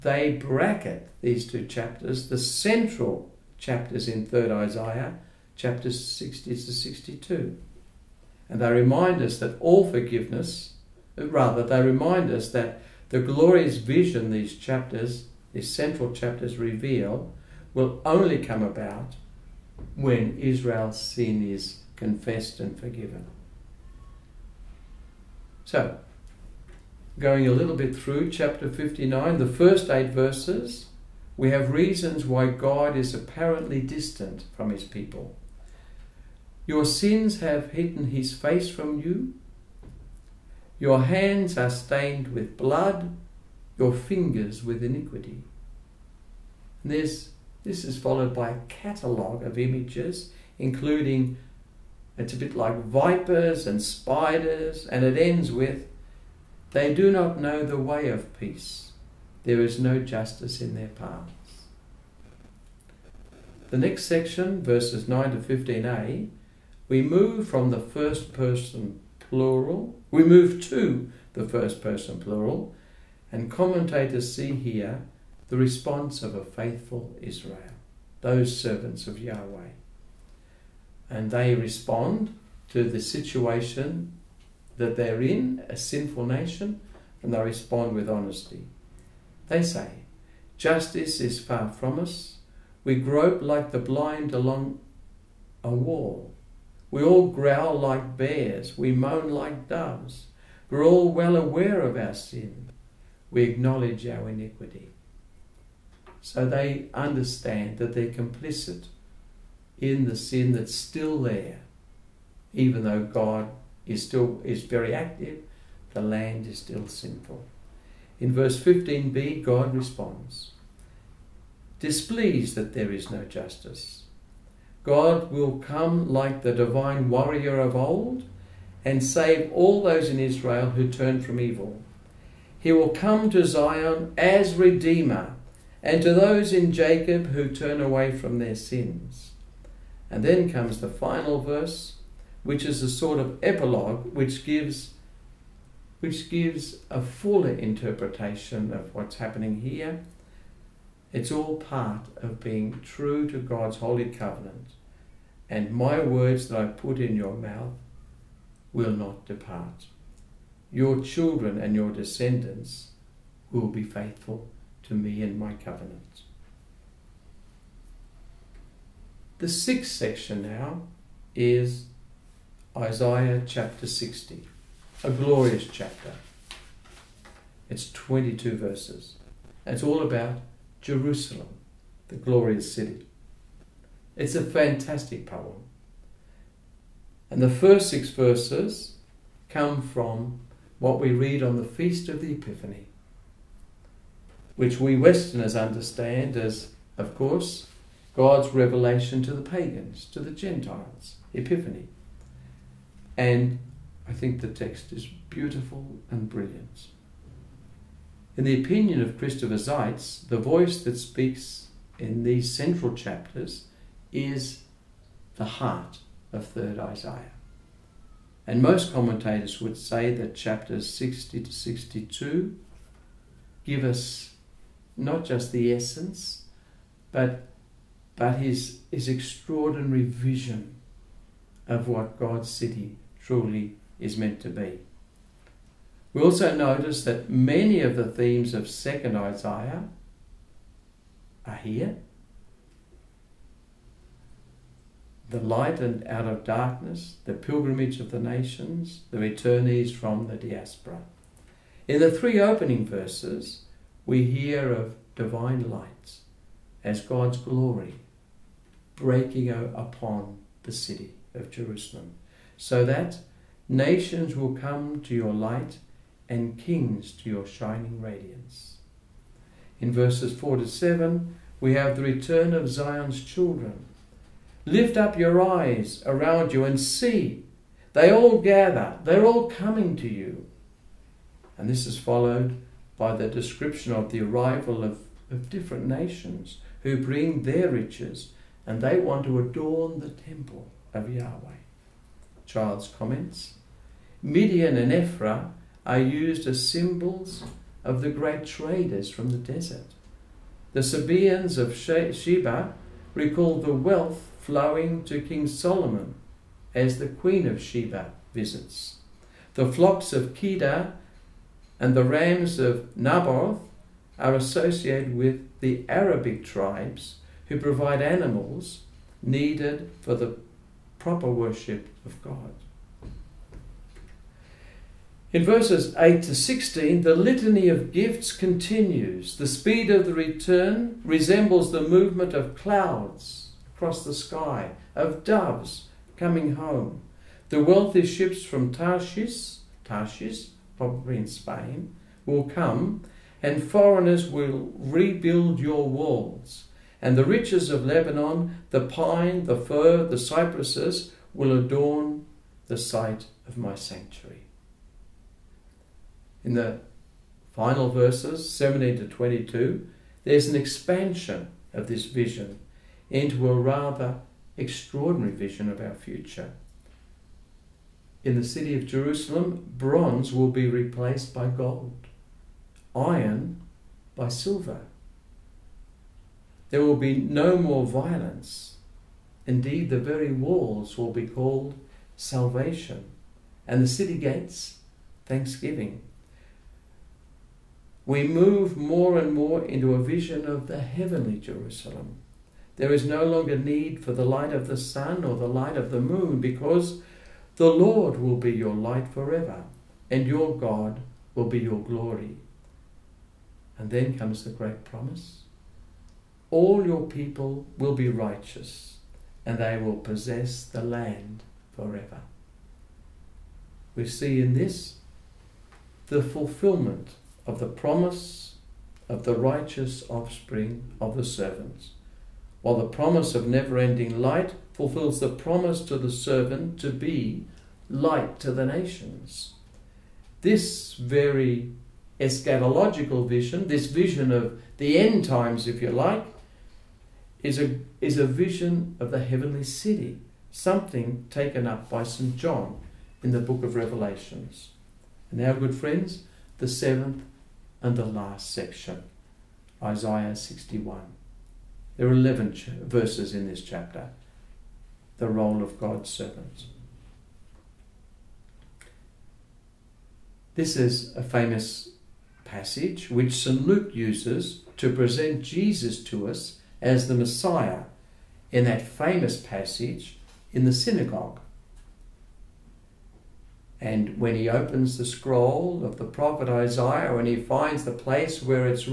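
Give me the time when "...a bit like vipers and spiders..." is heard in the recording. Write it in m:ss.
0:52.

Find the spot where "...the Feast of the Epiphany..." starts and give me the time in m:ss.
3:11.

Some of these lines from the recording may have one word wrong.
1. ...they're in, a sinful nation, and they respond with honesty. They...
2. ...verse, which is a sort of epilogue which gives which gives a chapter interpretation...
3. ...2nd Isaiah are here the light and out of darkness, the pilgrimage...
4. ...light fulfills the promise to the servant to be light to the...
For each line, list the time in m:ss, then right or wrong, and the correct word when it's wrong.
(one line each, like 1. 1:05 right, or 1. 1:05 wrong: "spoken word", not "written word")
1. 1:24 right
2. 2:21 wrong: "fuller", not "chapter"
3. 3:58 right
4. 7:04 right.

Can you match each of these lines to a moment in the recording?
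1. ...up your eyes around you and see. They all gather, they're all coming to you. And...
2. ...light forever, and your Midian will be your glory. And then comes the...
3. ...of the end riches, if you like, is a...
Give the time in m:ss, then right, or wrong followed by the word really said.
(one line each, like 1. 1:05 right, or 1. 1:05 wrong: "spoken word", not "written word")
1. 4:34 right
2. 6:38 wrong: "God", not "Midian"
3. 7:14 wrong: "times", not "riches".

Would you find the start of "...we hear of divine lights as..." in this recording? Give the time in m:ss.
4:14.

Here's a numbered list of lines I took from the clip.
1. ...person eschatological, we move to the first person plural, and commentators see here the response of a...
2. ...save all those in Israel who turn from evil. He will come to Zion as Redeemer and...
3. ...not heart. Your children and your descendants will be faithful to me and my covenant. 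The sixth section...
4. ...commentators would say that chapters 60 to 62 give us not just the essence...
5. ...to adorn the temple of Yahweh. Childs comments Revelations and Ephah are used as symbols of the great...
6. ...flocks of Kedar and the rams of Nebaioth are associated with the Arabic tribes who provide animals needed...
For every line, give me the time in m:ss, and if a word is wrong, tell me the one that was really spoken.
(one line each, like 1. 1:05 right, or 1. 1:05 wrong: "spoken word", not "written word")
1. 1:08 wrong: "plural", not "eschatological"
2. 2:09 right
3. 2:38 wrong: "depart", not "heart"
4. 3:38 right
5. 4:49 wrong: "Midian", not "Revelations"
6. 5:09 right.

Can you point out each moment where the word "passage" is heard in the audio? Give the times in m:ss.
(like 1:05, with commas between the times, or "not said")
7:42, 7:49.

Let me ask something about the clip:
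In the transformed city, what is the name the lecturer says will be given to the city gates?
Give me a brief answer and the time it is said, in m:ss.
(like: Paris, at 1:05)
thanksgiving, at 6:25.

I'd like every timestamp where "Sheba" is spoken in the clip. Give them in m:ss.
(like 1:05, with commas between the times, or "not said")
5:01, 5:07.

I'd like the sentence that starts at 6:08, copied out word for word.
In the city of Jerusalem, bronze will be replaced by gold, iron by silver.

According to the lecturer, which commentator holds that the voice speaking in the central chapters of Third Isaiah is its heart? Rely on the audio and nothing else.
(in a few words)
Christopher Seitz.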